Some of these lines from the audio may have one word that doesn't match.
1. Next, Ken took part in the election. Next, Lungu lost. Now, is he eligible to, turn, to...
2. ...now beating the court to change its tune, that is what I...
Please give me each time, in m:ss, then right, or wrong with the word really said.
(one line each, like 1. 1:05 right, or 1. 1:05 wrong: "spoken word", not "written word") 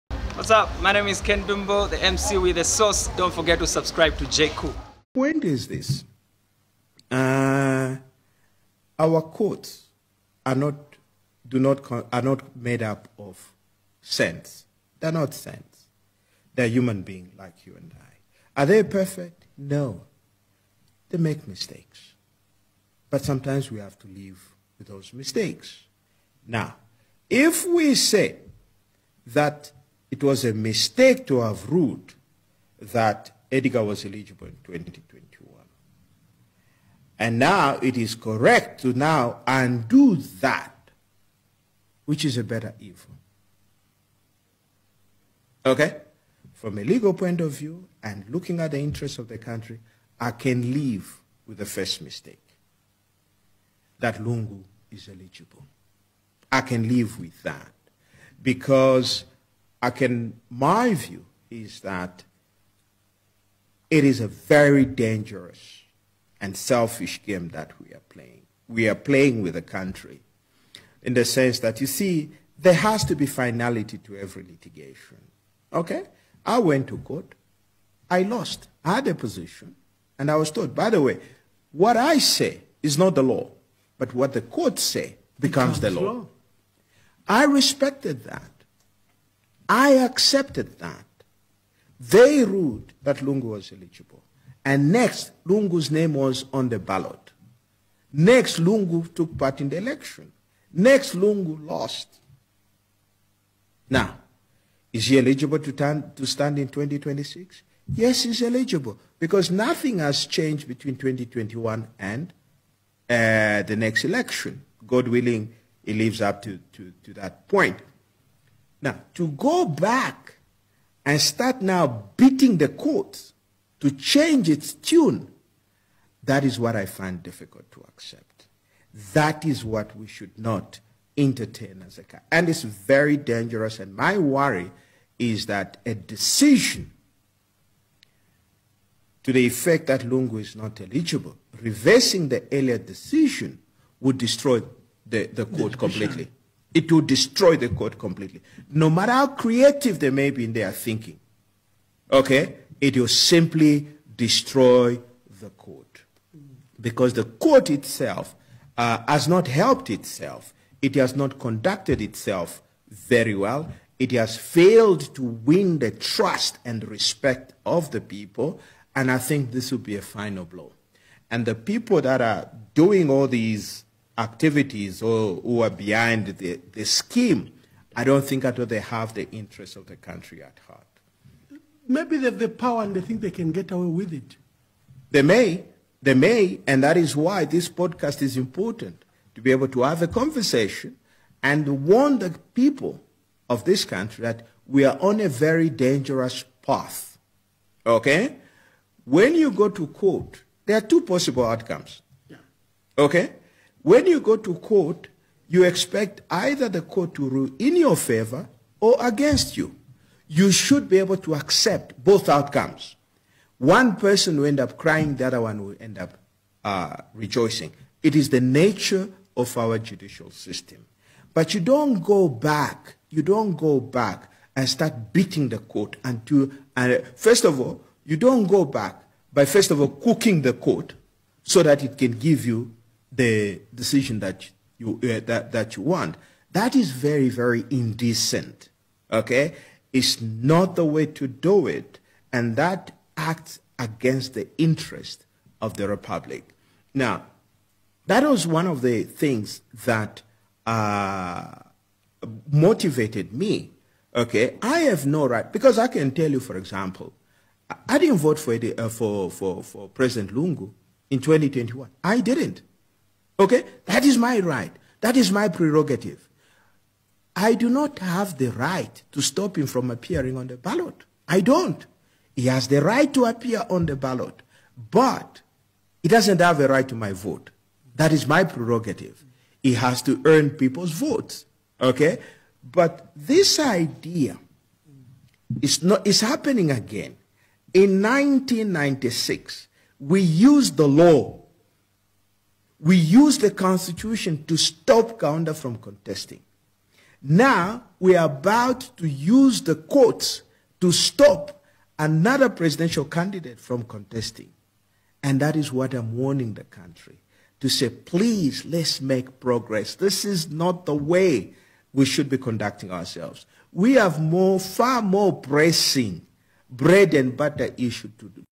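1. 1:38 wrong: "Lungu", not "Ken"
2. 2:01 right.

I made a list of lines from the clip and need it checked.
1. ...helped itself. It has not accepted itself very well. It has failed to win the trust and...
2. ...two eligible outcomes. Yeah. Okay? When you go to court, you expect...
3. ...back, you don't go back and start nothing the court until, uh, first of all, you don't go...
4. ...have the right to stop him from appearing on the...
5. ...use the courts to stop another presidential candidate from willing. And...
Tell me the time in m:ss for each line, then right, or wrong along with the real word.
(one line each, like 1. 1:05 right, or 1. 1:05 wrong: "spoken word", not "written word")
1. 2:39 wrong: "conducted", not "accepted"
2. 3:20 wrong: "possible", not "eligible"
3. 3:42 wrong: "beating", not "nothing"
4. 4:27 right
5. 4:59 wrong: "contesting", not "willing".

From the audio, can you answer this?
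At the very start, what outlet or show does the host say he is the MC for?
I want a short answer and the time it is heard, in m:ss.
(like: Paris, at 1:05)
The Source, at 0:02.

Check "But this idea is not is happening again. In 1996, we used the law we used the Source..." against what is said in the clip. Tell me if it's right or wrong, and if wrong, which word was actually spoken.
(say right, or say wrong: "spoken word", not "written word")
wrong: "Constitution", not "Source".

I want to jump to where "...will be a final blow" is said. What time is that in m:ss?
2:49.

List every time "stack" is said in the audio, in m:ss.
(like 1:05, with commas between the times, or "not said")
not said.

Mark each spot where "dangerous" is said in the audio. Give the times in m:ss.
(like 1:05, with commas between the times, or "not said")
1:04, 2:13, 3:15.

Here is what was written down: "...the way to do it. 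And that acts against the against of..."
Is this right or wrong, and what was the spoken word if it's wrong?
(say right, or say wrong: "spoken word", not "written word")
wrong: "interest", not "against".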